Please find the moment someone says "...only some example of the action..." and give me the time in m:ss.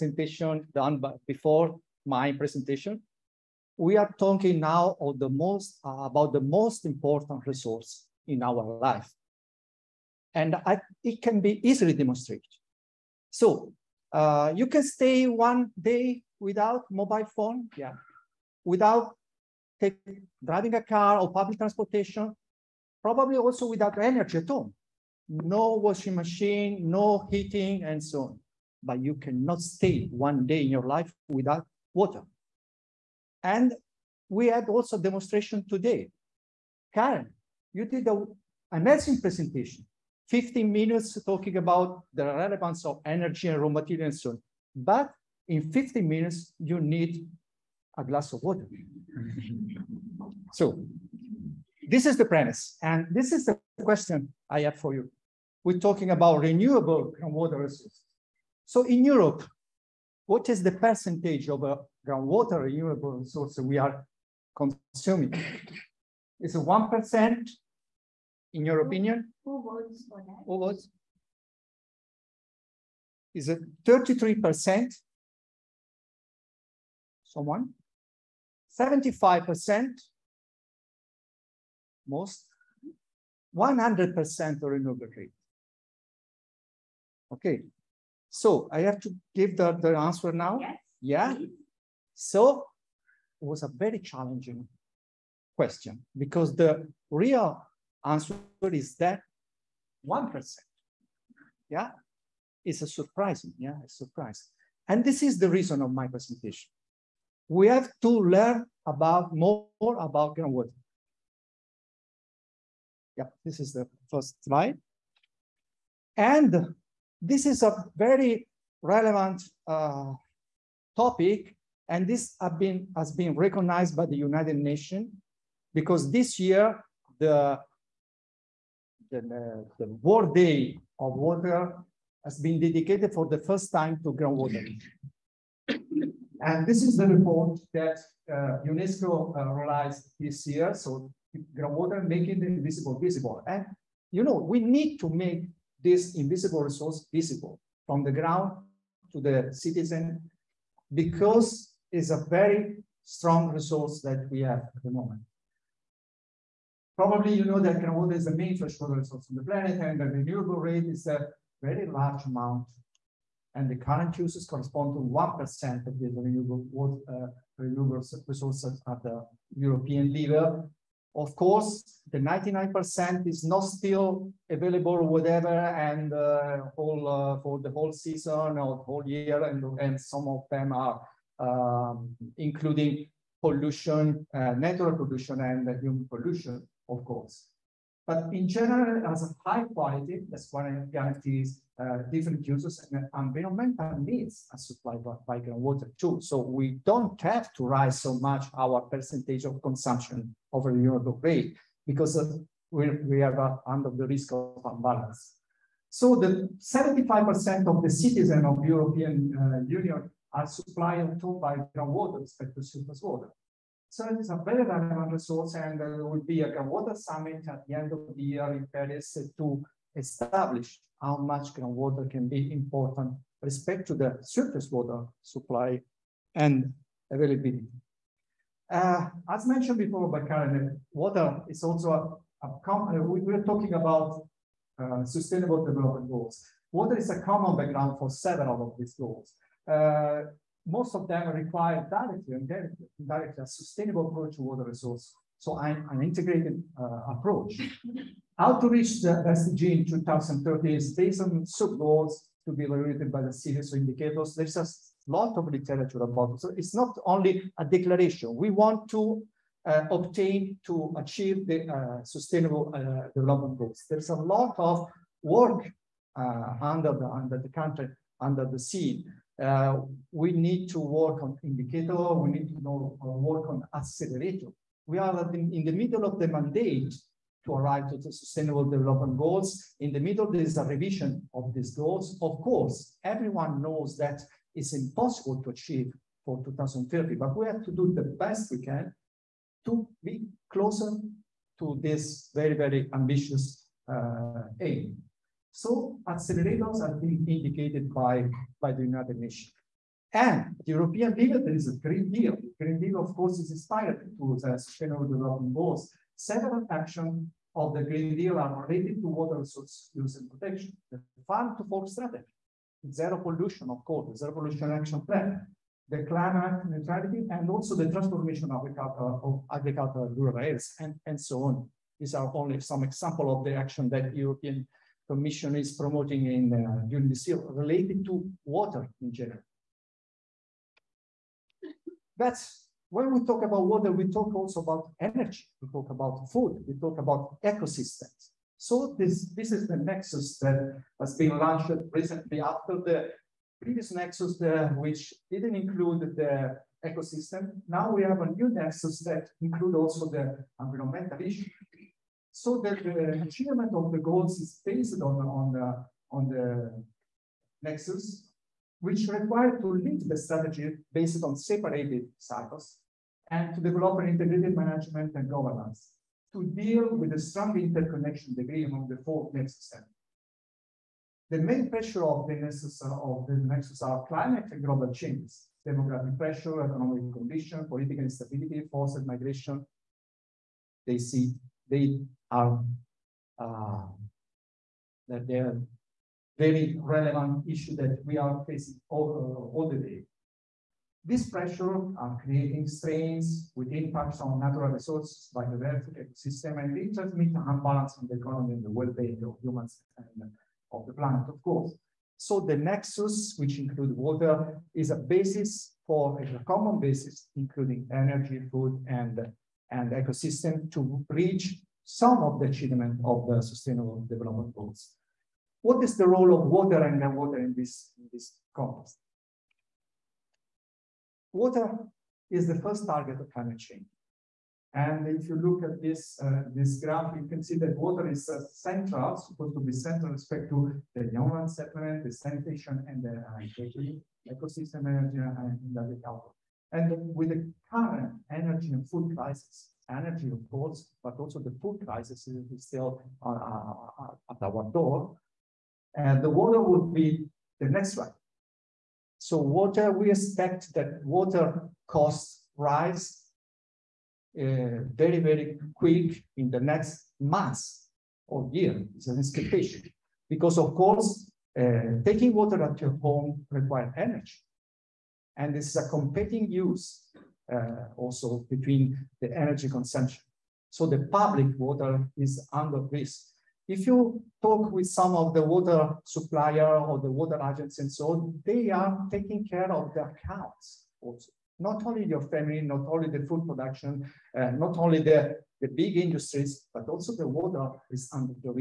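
5:22.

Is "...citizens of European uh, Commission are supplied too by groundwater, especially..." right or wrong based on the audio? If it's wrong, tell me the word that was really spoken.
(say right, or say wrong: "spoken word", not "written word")
wrong: "Union", not "Commission".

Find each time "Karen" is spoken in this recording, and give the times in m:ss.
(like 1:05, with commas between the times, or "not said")
0:36, 3:50.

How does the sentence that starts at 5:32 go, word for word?
That's when we talk about water, we talk also about energy, we talk about food, we talk about ecosystems.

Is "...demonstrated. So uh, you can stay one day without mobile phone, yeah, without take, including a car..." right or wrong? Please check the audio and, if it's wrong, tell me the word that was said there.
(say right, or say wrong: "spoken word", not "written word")
wrong: "driving", not "including".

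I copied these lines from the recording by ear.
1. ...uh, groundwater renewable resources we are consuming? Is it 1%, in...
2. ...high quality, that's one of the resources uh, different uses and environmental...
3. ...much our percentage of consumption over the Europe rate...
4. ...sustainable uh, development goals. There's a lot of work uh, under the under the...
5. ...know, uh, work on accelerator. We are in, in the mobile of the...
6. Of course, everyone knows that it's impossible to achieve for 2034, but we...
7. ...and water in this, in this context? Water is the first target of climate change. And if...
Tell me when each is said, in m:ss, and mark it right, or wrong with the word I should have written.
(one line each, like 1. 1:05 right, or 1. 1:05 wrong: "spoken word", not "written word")
1. 1:01 right
2. 3:09 wrong: "guarantees", not "resources"
3. 3:18 right
4. 4:22 right
5. 4:32 wrong: "middle", not "mobile"
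6. 4:42 wrong: "2030", not "2034"
7. 6:56 wrong: "groundwater", not "water".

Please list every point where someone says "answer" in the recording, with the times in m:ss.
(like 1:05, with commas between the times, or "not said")
1:29, 1:38.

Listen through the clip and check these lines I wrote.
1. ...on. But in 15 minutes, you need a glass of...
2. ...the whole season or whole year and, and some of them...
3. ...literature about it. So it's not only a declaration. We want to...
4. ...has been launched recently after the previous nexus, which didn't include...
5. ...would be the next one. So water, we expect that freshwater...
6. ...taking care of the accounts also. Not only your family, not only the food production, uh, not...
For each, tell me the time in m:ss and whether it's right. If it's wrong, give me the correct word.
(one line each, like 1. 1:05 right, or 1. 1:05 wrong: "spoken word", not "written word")
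1. 0:44 right
2. 2:57 right
3. 4:15 right
4. 5:40 right
5. 7:26 wrong: "water", not "freshwater"
6. 7:59 right.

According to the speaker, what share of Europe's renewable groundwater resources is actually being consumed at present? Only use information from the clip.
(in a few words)
1%.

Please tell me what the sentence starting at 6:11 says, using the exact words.
The main pressure of the nexus of the nexus are climate and global changes, demographic pressure, economic condition, political instability, forced migration.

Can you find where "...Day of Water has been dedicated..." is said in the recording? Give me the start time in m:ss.
2:10.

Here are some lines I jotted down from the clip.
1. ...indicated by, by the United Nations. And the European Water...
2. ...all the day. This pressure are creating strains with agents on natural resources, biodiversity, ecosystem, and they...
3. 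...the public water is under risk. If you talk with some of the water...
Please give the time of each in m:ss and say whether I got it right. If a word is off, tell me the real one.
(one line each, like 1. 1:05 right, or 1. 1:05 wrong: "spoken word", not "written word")
1. 4:57 wrong: "Deal", not "Water"
2. 6:29 wrong: "impacts", not "agents"
3. 7:50 right.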